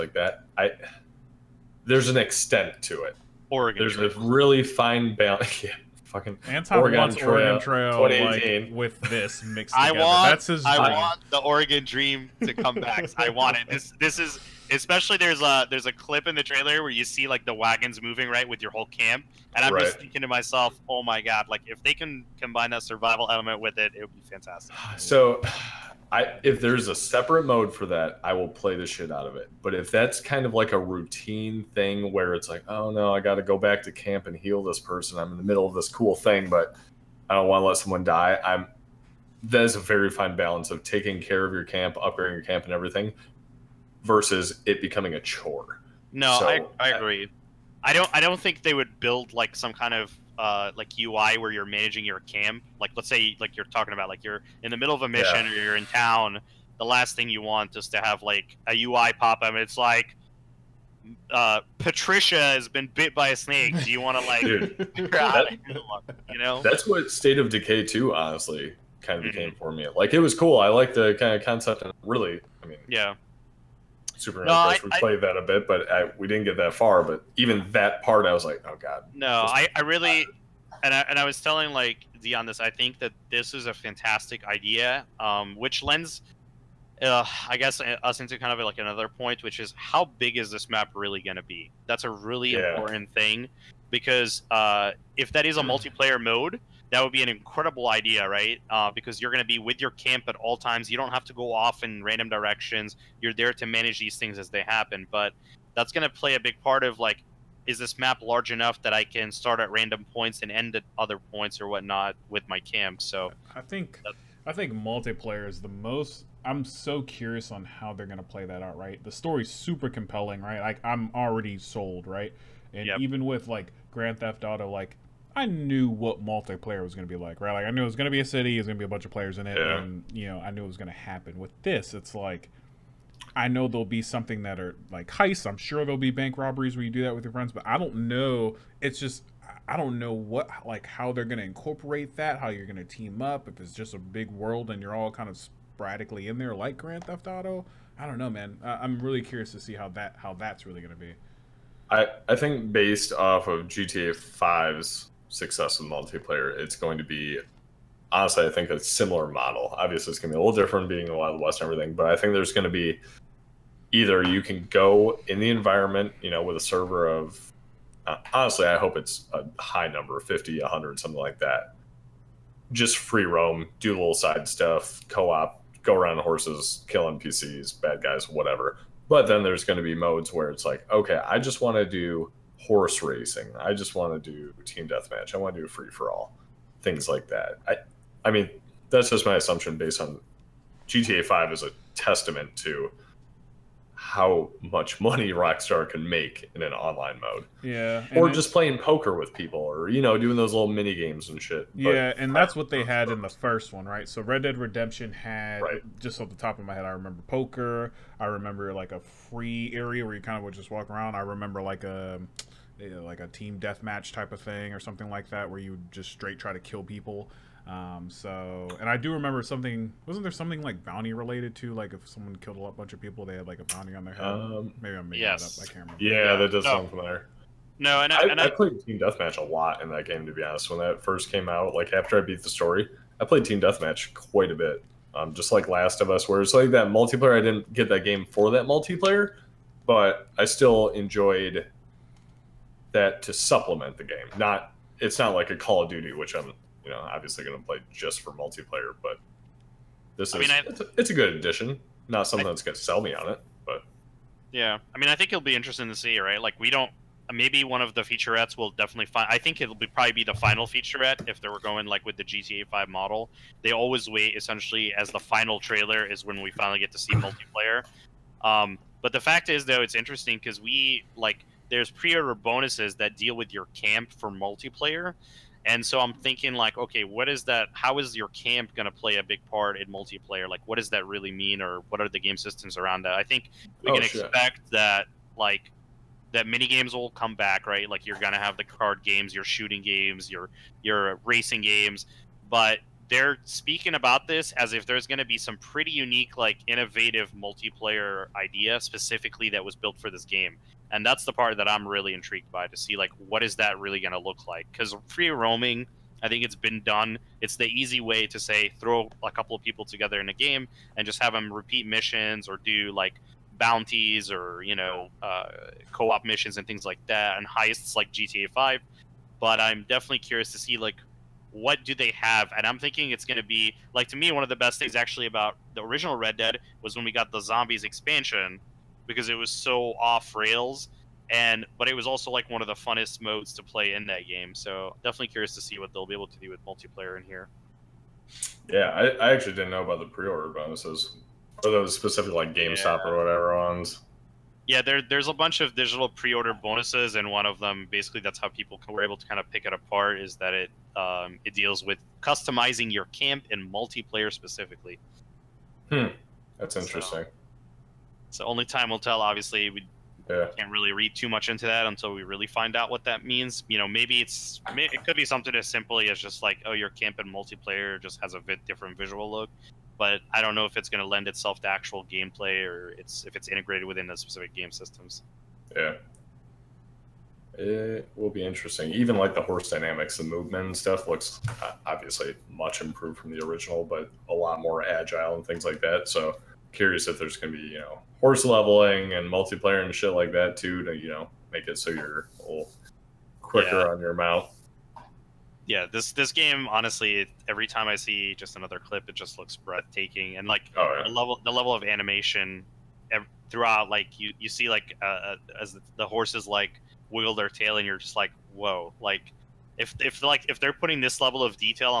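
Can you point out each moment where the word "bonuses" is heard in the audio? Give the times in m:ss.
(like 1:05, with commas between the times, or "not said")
4:32, 5:40, 5:46.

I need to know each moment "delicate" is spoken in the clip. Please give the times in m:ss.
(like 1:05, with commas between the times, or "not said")
not said.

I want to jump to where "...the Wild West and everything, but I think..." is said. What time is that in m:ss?
2:41.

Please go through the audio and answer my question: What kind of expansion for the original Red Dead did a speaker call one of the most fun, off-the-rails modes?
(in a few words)
zombies.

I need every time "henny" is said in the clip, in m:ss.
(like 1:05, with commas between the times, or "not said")
not said.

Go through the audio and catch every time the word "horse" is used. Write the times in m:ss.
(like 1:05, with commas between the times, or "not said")
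2:56, 3:02, 6:19, 6:28, 6:46.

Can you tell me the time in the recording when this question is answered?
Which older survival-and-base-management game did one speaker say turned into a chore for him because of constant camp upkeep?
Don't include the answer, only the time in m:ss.
1:07.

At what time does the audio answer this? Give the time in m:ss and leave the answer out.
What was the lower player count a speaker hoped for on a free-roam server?
2:50.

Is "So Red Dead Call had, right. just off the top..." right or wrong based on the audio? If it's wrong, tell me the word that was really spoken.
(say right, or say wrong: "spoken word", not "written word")
wrong: "Redemption", not "Call".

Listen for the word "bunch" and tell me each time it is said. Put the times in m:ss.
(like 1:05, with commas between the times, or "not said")
2:08, 3:42, 5:45.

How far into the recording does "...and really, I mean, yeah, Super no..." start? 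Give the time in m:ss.
1:11.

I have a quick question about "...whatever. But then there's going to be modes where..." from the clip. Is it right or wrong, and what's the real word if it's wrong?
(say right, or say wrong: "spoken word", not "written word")
right.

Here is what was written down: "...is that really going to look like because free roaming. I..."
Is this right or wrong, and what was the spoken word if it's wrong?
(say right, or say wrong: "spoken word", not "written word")
right.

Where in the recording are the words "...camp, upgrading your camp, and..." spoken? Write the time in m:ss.
0:41.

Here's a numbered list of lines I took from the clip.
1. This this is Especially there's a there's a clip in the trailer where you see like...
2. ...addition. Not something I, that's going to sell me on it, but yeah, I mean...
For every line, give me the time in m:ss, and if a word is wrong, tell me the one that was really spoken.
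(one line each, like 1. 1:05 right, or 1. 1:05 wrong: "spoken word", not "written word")
1. 0:13 right
2. 4:11 right.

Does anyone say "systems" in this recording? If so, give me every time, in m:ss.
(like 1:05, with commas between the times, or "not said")
4:42, 6:14.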